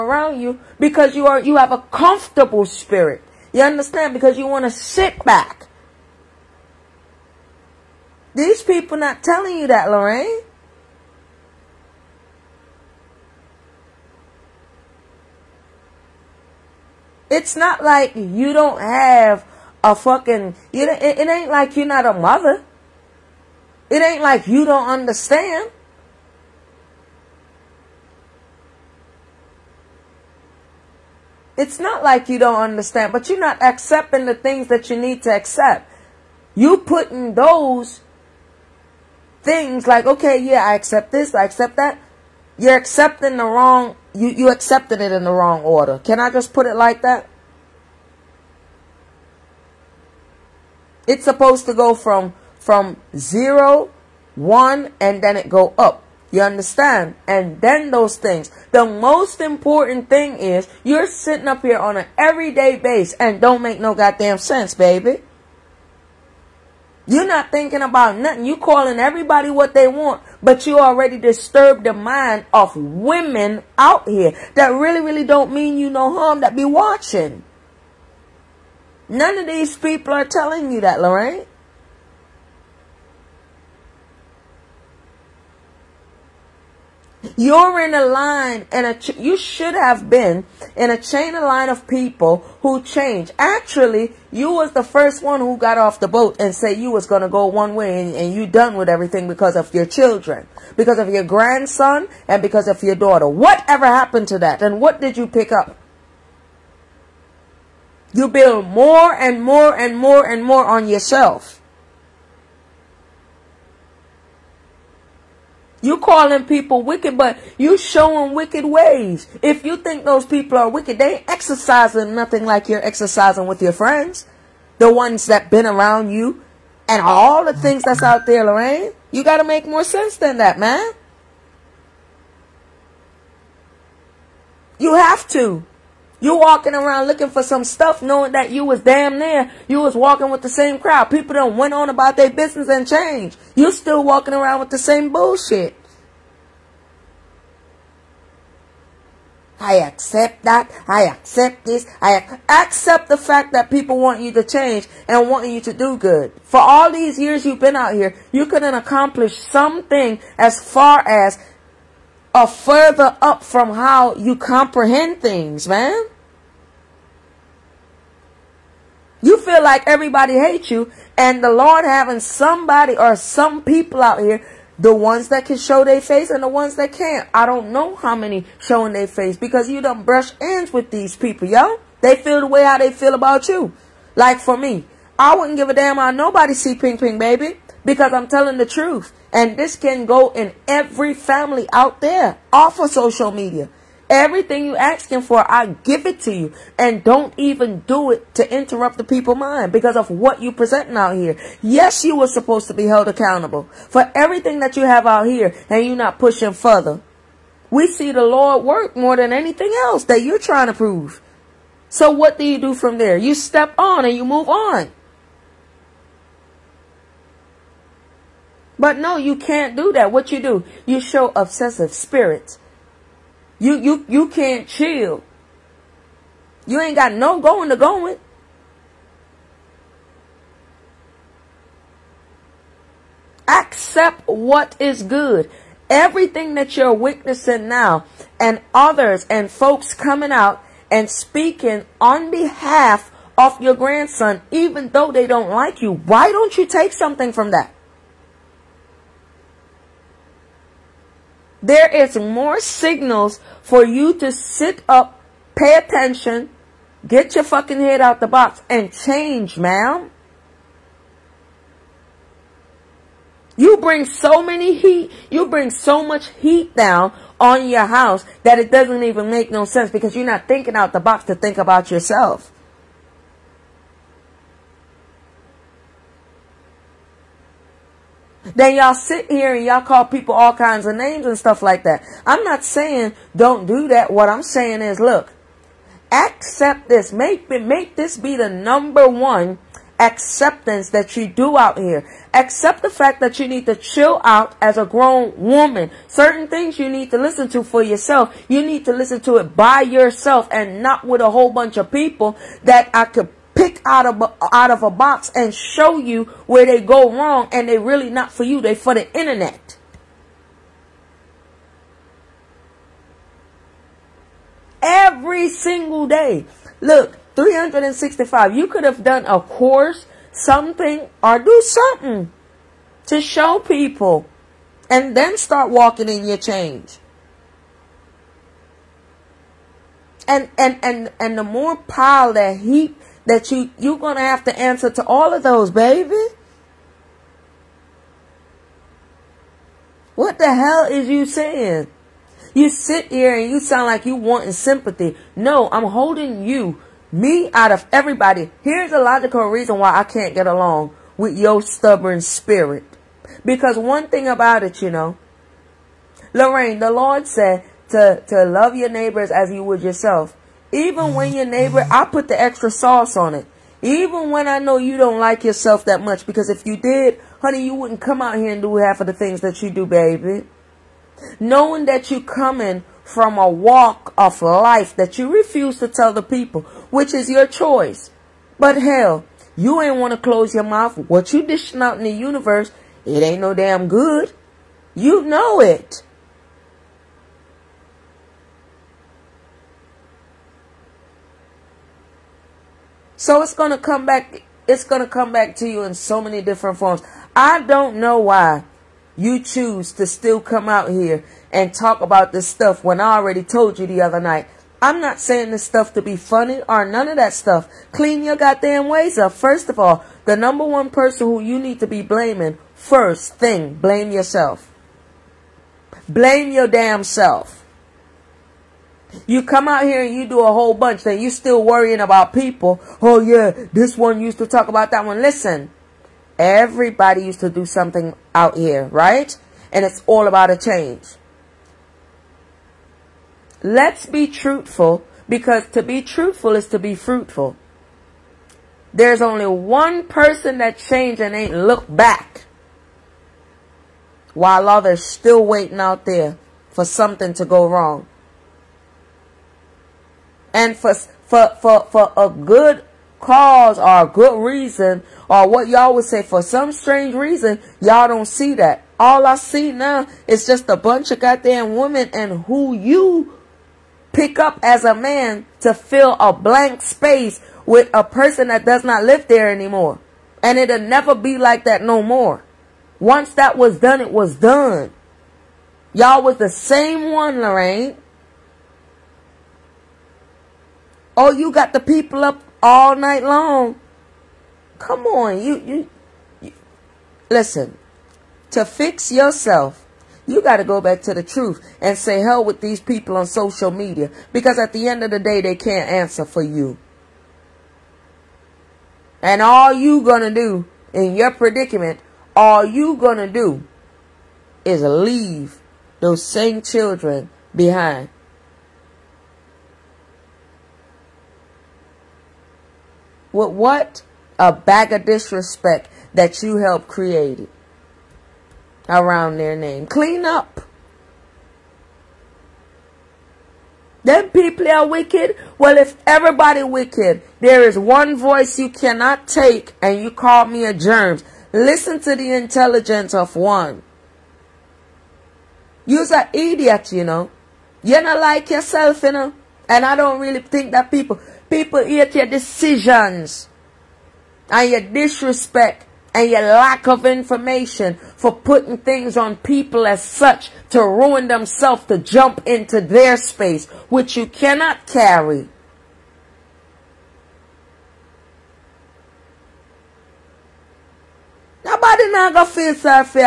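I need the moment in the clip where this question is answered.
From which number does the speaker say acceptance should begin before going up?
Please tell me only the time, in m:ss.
0:53.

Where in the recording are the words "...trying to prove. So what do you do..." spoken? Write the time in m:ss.
3:30.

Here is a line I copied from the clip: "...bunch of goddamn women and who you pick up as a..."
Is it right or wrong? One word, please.
right.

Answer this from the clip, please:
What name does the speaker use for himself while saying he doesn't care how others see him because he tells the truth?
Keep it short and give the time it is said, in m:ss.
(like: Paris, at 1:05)
Ping Ping Baby, at 3:06.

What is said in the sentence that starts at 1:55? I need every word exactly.
You calling people wicked, but you showing wicked ways.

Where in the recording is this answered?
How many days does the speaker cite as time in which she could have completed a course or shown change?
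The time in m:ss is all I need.
5:17.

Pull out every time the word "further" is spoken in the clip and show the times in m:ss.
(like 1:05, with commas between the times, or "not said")
2:42, 3:26.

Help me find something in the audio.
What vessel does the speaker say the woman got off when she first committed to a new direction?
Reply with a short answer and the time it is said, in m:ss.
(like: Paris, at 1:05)
the boat, at 1:35.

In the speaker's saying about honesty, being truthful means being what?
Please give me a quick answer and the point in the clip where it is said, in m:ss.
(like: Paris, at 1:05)
fruitful, at 7:16.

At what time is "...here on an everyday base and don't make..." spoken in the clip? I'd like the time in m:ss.
1:01.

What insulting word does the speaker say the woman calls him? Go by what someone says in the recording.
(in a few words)
a germ.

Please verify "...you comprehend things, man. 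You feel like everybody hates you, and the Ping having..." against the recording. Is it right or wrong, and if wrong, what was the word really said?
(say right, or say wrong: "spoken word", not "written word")
wrong: "Lord", not "Ping".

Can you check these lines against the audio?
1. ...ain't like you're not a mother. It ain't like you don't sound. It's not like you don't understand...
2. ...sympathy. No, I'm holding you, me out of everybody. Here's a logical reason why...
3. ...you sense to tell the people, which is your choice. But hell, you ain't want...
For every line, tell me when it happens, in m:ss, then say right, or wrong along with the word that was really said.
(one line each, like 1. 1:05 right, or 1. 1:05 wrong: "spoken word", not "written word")
1. 0:21 wrong: "understand", not "sound"
2. 5:44 right
3. 6:15 wrong: "refuse", not "sense".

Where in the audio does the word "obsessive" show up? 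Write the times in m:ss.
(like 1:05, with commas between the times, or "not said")
3:41.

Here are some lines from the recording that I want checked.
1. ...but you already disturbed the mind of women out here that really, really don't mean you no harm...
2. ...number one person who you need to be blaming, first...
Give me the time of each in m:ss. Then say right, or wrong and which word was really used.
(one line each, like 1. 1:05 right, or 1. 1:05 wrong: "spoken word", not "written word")
1. 1:10 right
2. 6:50 right.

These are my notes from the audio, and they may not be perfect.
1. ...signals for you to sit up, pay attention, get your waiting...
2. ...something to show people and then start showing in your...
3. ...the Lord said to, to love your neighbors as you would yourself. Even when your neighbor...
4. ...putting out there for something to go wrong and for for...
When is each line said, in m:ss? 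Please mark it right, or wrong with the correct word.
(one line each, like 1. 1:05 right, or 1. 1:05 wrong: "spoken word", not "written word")
1. 4:12 wrong: "fucking", not "waiting"
2. 5:21 wrong: "walking", not "showing"
3. 5:56 right
4. 7:25 wrong: "waiting", not "putting".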